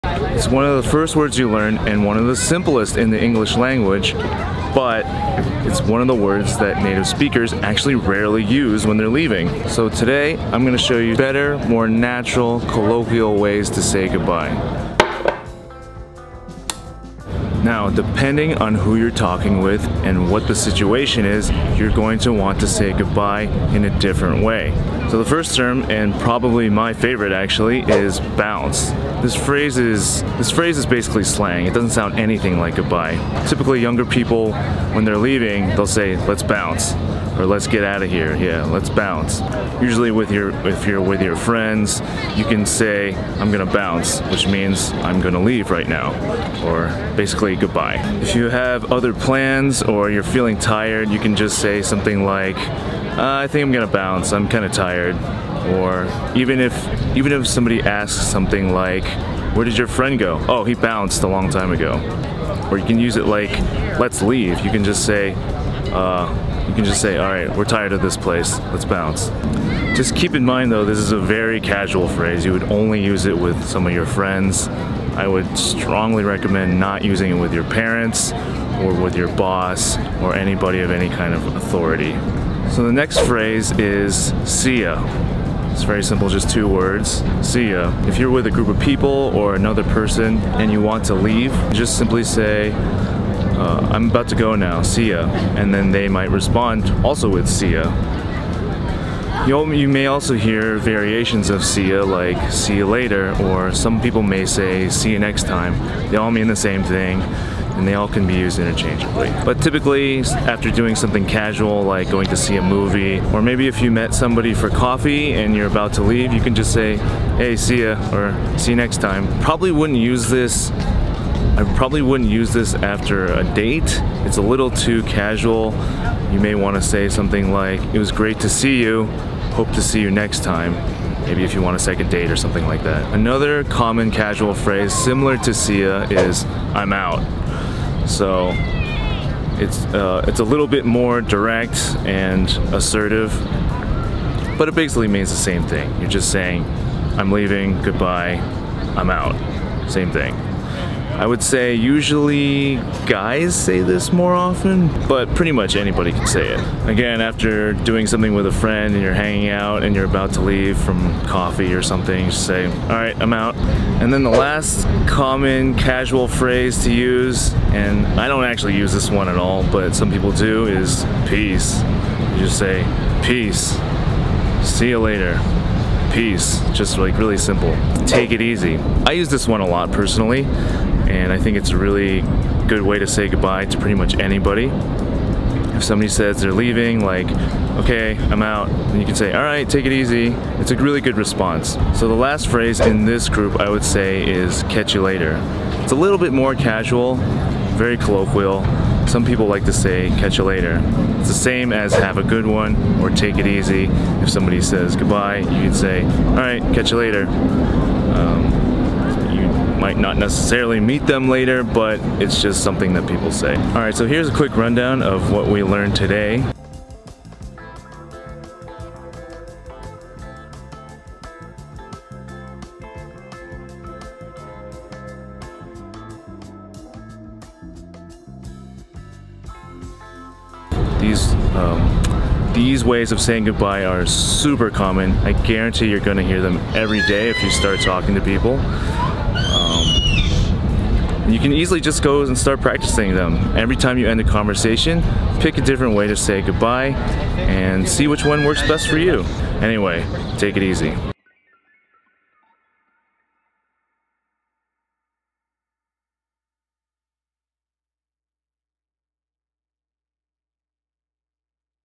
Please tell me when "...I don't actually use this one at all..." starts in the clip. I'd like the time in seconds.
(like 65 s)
168 s.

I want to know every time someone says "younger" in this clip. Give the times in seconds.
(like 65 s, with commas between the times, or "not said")
33 s.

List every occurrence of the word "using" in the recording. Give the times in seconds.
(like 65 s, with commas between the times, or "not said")
77 s.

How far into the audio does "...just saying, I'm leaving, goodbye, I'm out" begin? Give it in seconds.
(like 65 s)
146 s.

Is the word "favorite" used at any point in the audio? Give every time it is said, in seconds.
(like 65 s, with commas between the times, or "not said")
26 s.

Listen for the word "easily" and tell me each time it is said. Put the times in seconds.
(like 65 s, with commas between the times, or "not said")
241 s.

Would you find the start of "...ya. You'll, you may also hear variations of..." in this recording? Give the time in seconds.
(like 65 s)
97 s.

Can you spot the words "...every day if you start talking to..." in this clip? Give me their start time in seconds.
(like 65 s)
236 s.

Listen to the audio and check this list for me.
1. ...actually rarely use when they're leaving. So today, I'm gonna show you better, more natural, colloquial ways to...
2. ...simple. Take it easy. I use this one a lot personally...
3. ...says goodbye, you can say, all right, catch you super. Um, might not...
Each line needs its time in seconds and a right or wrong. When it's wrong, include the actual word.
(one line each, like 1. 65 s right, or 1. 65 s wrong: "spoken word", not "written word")
1. 7 s right
2. 177 s right
3. 204 s wrong: "later", not "super".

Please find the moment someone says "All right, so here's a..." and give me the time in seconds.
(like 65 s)
213 s.